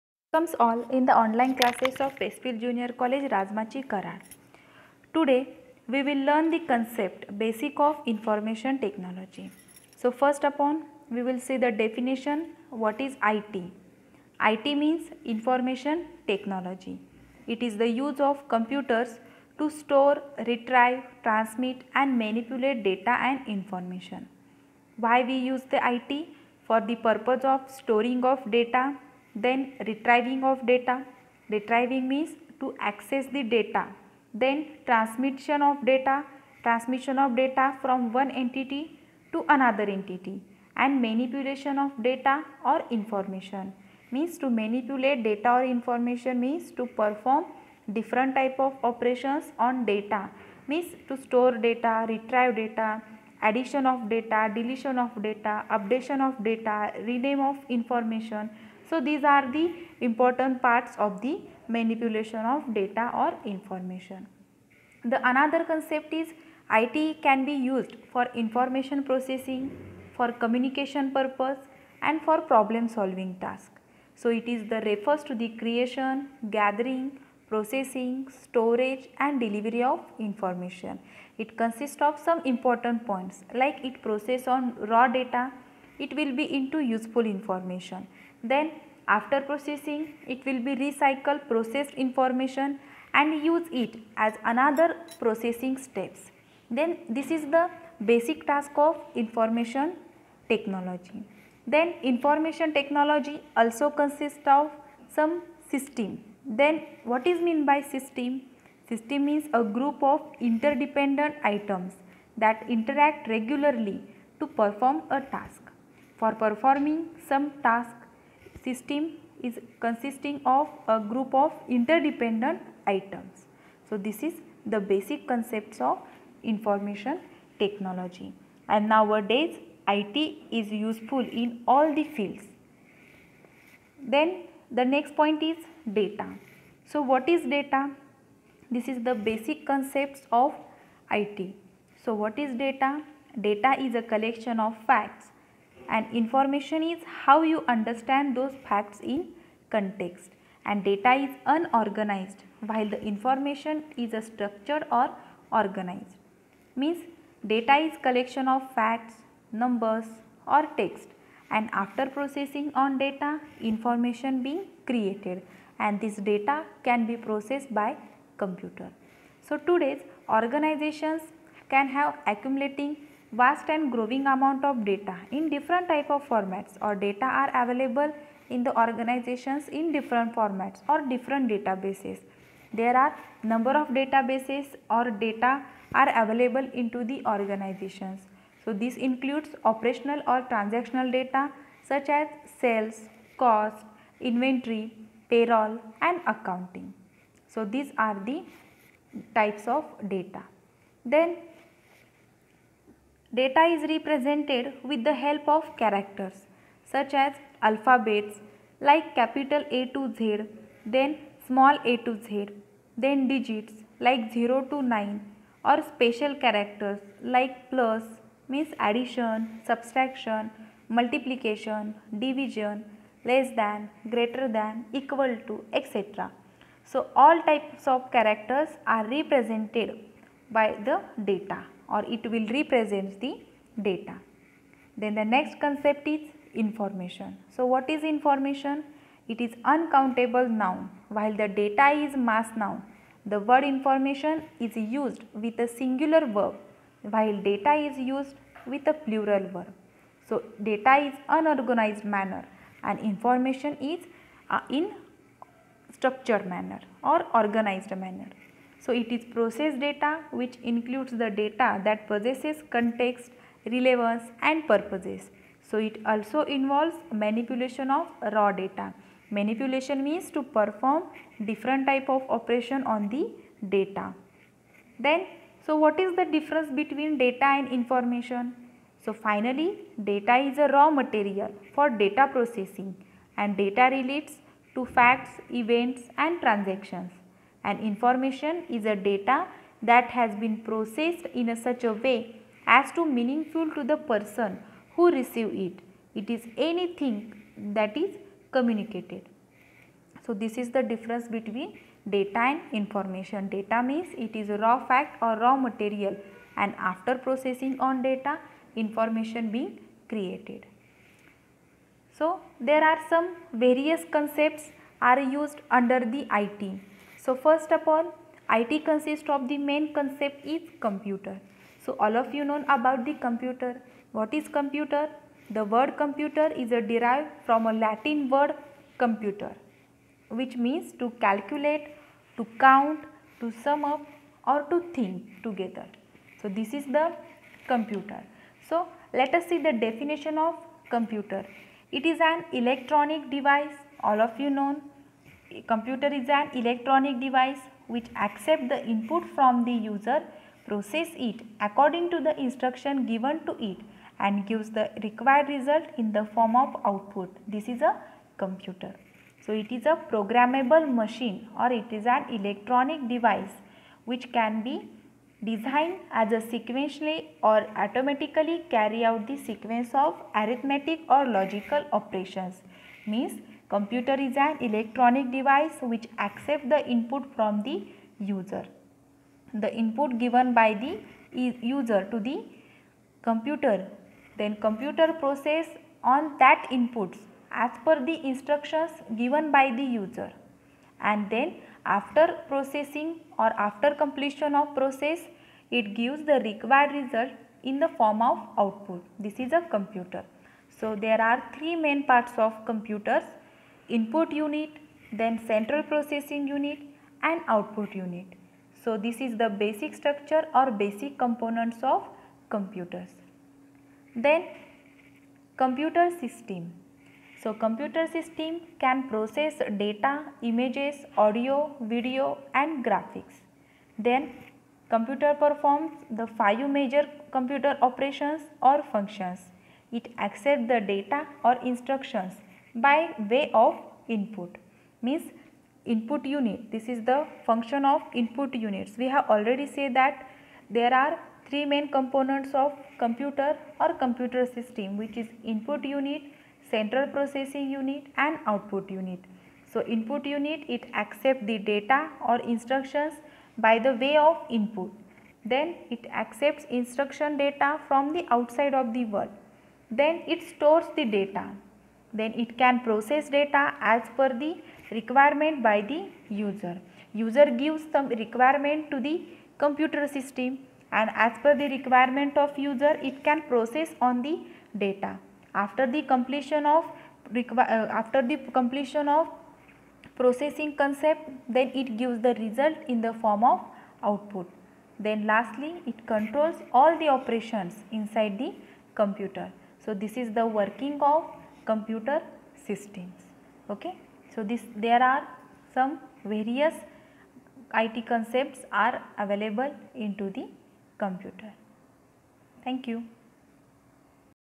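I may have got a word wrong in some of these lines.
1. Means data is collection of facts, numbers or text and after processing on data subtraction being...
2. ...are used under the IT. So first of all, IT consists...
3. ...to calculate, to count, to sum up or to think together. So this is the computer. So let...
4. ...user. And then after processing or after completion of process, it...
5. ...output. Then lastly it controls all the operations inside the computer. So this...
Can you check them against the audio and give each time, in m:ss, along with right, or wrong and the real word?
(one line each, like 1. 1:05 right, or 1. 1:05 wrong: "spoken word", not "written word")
1. 2:36 wrong: "information", not "subtraction"
2. 5:15 right
3. 5:30 right
4. 6:29 right
5. 8:04 right.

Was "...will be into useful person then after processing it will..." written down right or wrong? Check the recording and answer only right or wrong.
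wrong.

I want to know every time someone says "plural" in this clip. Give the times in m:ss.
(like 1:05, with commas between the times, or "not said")
4:08.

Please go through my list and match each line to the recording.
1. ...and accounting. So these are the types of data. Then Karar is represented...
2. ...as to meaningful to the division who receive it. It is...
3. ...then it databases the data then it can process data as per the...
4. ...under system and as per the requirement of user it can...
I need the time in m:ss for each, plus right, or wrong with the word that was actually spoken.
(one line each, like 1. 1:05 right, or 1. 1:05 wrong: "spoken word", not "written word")
1. 3:16 wrong: "Data", not "Karar"
2. 4:52 wrong: "person", not "division"
3. 7:39 wrong: "stores", not "databases"
4. 7:49 wrong: "computer", not "under".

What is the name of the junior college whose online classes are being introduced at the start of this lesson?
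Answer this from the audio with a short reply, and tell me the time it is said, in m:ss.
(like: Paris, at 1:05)
Westfield Junior College, at 0:02.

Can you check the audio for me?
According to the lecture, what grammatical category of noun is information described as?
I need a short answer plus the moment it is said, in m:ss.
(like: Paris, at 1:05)
Uncountable noun, at 3:59.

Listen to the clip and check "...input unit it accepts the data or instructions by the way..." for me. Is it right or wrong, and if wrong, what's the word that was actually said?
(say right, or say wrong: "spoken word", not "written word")
right.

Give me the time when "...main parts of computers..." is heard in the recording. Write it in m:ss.
6:41.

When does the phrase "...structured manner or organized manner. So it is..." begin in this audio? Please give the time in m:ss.
4:15.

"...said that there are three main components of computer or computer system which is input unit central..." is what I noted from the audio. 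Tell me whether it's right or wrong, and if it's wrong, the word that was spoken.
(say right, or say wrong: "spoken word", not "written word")
right.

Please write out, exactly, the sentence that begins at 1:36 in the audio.
Then this is the basic task of information technology.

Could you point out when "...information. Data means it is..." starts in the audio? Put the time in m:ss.
5:02.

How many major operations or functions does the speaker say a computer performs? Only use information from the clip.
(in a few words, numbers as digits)
5.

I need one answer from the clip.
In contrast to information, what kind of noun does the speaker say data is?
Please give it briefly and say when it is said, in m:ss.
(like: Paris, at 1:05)
Mass noun, at 4:02.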